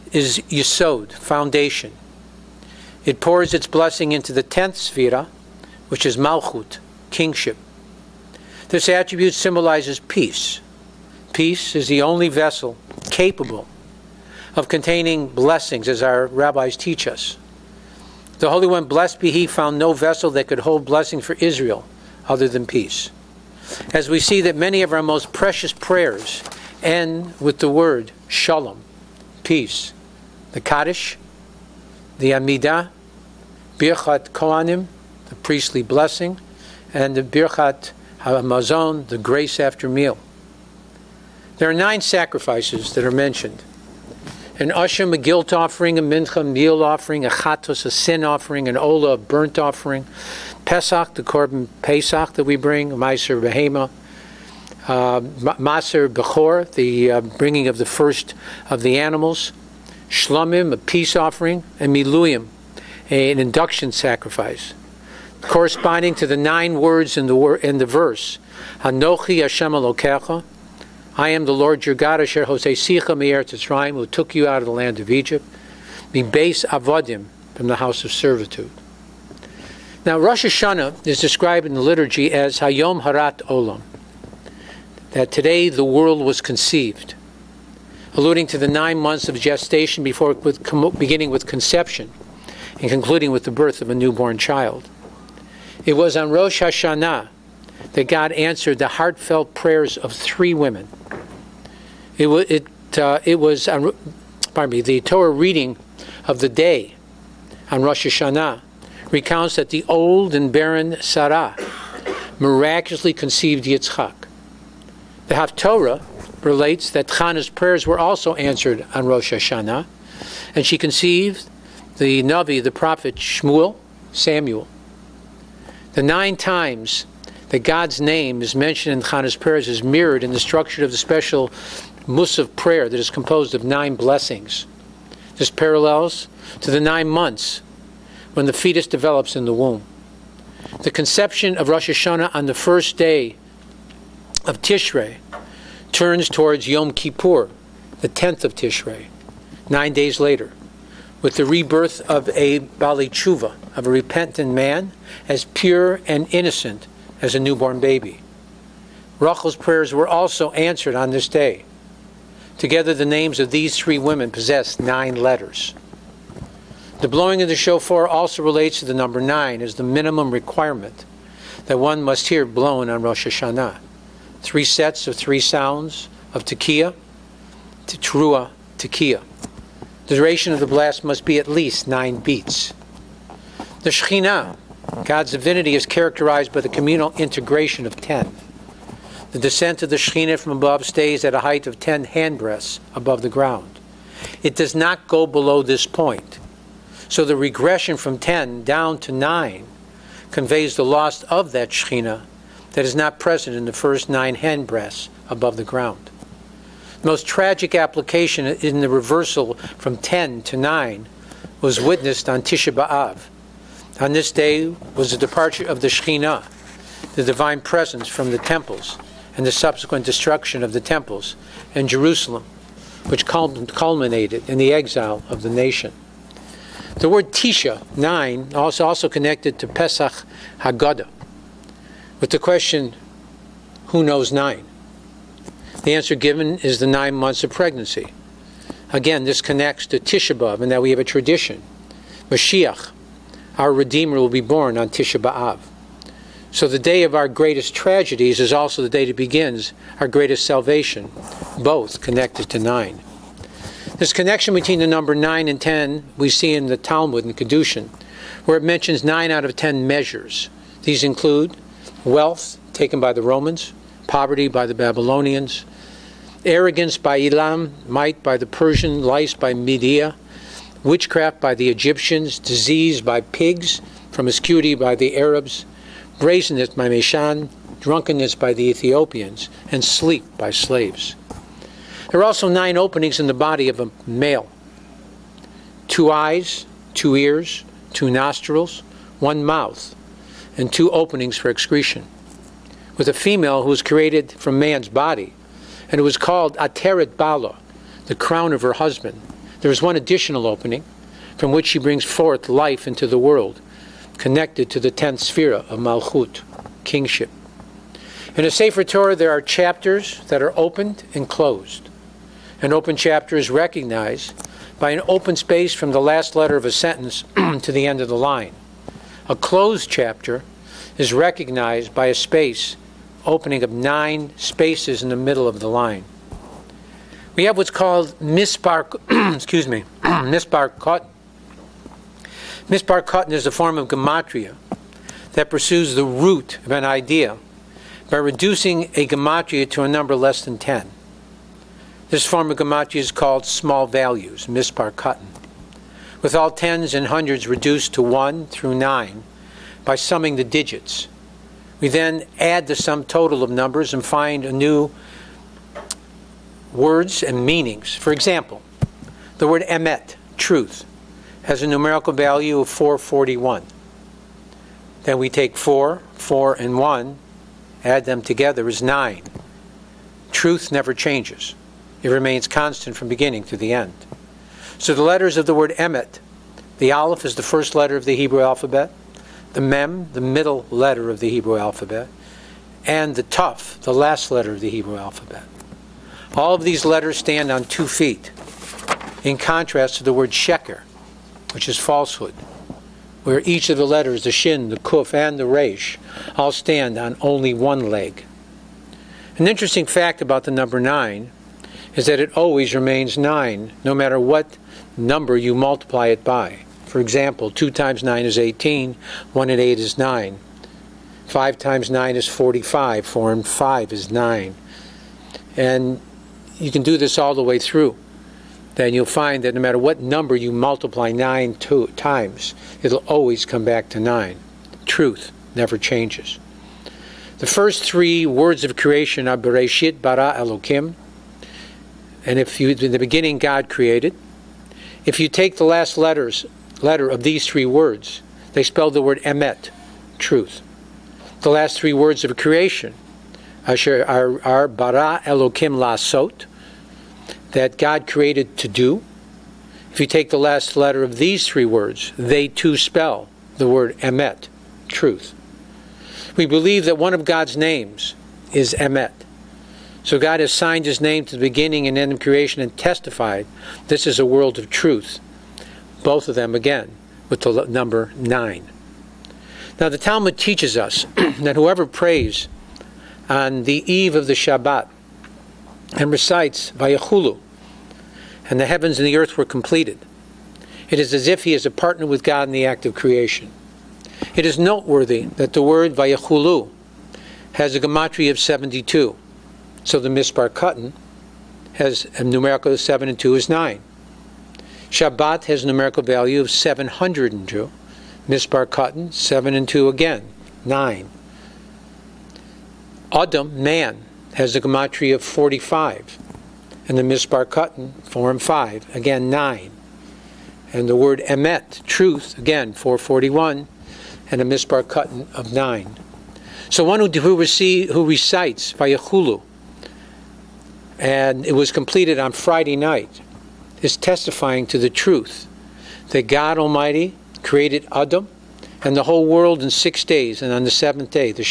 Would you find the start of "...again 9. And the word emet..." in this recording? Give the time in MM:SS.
08:28.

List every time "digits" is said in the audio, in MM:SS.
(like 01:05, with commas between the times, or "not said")
05:50.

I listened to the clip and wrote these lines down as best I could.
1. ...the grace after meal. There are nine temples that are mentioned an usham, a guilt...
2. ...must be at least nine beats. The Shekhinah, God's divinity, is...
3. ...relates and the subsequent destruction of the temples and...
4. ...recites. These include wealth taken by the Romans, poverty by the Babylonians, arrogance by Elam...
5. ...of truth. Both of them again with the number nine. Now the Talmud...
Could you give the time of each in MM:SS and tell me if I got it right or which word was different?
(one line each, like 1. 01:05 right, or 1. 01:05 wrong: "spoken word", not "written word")
1. 00:39 wrong: "sacrifices", not "temples"
2. 03:01 right
3. 03:38 wrong: "temples", not "relates"
4. 04:19 wrong: "measures", not "recites"
5. 07:44 right.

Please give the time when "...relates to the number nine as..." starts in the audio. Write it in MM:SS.
02:48.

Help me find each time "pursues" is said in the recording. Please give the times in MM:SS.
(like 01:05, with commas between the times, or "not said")
05:35.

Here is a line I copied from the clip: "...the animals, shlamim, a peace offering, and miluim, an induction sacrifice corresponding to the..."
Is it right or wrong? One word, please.
right.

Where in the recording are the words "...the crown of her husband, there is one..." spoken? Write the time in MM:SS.
04:58.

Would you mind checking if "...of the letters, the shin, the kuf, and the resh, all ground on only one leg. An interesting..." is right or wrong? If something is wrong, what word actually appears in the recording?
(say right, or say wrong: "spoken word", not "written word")
wrong: "stand", not "ground".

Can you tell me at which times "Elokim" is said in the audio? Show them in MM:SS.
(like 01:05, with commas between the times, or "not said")
07:10, 07:25.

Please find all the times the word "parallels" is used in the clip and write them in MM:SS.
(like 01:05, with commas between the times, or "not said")
02:15.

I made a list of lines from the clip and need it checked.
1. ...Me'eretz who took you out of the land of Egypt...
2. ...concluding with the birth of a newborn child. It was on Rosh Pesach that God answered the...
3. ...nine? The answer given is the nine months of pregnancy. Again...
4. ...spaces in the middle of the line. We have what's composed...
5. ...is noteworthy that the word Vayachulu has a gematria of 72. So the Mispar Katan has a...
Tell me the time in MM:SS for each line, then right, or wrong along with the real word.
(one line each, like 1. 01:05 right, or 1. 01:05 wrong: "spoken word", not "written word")
1. 01:13 right
2. 01:32 wrong: "Hashanah", not "Pesach"
3. 03:54 right
4. 05:24 wrong: "called", not "composed"
5. 08:04 right.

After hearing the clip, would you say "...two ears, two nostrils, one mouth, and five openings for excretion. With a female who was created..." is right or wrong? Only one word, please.
wrong.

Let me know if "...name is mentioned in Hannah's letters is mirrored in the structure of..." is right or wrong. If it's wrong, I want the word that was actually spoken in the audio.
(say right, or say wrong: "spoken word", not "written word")
wrong: "prayers", not "letters".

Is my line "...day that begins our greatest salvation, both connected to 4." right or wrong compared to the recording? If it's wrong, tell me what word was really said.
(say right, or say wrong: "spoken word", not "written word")
wrong: "9", not "4".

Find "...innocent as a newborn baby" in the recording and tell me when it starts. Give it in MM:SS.
02:36.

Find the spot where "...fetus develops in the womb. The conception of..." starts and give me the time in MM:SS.
02:18.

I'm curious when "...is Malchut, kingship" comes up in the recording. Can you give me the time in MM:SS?
00:06.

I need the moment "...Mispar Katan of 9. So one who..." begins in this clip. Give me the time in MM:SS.
08:34.